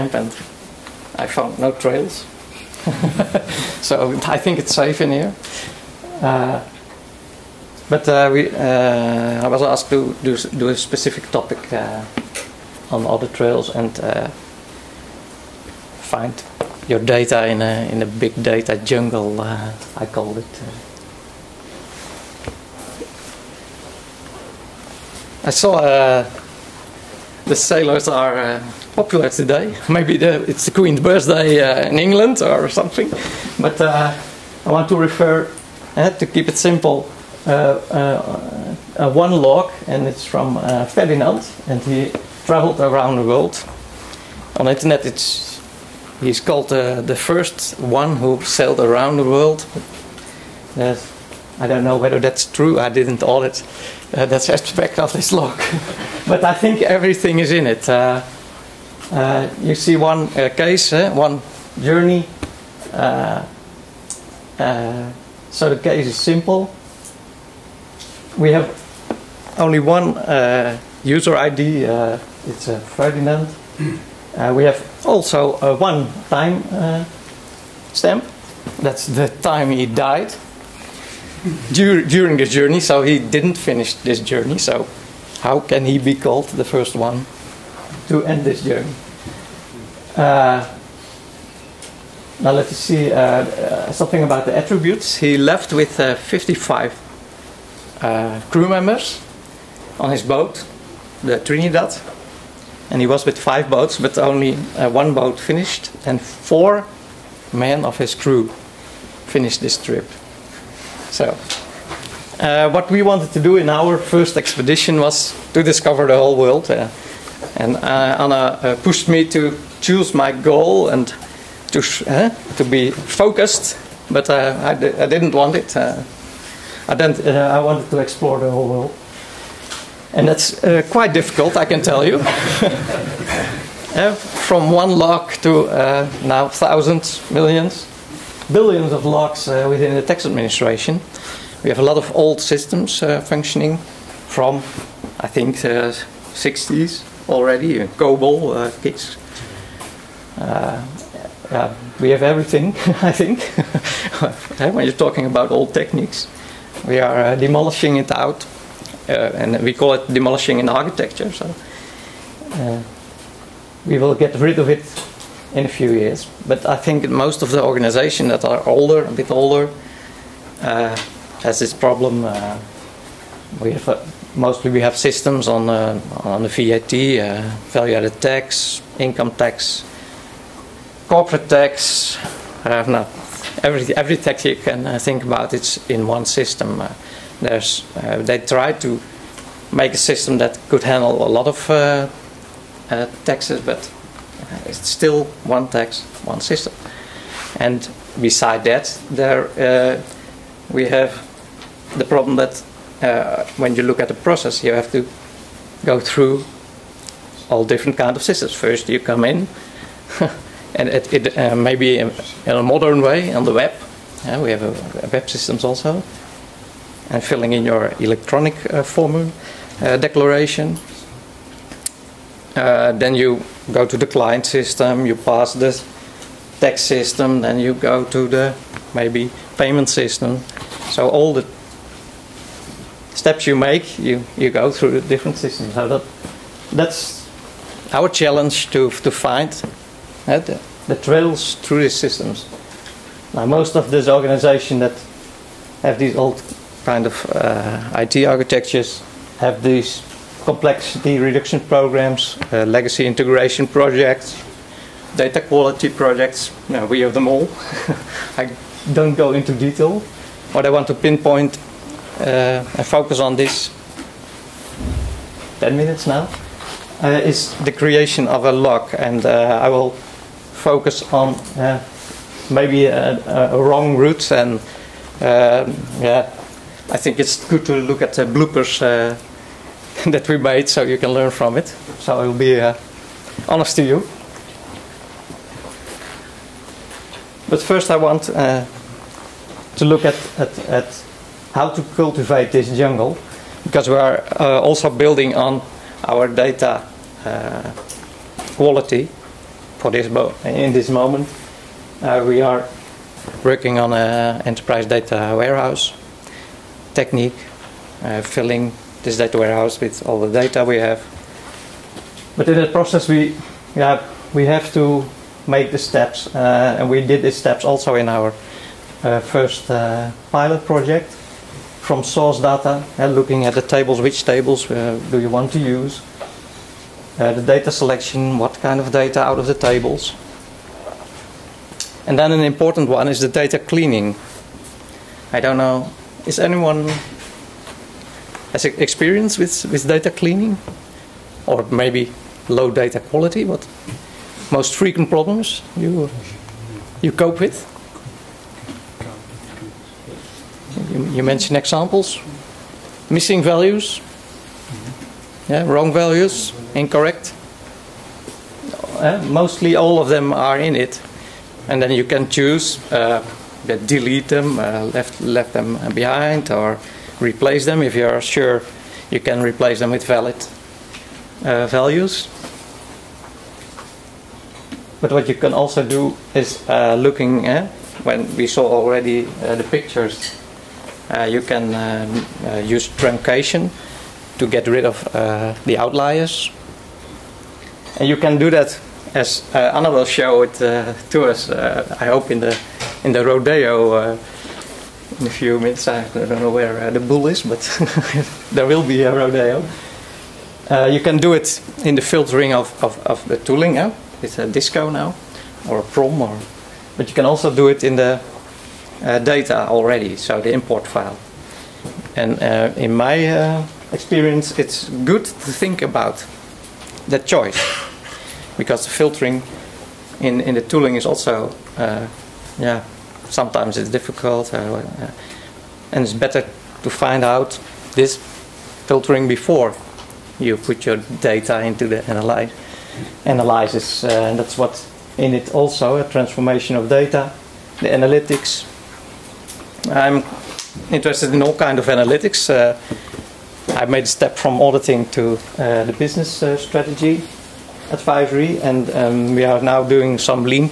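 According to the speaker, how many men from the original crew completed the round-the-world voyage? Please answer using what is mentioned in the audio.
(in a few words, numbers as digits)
4.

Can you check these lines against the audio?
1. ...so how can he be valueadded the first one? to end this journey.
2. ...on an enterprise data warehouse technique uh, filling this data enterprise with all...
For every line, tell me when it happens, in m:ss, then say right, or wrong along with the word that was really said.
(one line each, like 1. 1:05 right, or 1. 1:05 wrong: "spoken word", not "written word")
1. 1:24 wrong: "called", not "valueadded"
2. 5:03 wrong: "warehouse", not "enterprise".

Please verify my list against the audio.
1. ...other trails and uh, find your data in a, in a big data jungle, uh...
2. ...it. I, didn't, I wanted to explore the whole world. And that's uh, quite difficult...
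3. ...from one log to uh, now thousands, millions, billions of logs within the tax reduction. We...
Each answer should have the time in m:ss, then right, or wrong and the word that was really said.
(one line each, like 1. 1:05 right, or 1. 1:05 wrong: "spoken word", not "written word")
1. 0:13 right
2. 2:05 right
3. 2:14 wrong: "administration", not "reduction".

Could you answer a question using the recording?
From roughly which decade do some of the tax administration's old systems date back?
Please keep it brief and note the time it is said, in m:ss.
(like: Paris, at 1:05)
the 60s, at 2:25.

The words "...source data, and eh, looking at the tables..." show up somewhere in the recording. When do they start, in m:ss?
5:22.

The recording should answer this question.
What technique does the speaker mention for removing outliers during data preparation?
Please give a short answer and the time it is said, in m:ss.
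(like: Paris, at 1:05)
truncation, at 6:22.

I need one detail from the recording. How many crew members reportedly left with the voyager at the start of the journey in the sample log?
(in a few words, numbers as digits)
55.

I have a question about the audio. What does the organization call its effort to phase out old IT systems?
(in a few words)
demolishing in architecture.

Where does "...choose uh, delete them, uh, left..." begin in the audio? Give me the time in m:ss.
6:02.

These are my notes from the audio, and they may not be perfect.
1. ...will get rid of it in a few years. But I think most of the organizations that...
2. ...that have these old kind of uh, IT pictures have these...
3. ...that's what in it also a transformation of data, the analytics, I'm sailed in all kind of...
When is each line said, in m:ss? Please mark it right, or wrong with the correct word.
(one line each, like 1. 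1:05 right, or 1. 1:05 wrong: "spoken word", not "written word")
1. 2:43 right
2. 4:04 wrong: "architectures", not "pictures"
3. 7:14 wrong: "interested", not "sailed".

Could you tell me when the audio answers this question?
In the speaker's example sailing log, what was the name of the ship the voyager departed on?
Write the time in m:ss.
1:41.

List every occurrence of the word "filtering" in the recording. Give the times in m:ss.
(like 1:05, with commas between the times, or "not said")
6:42, 6:58, 7:08.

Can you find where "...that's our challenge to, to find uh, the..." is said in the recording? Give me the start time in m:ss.
3:56.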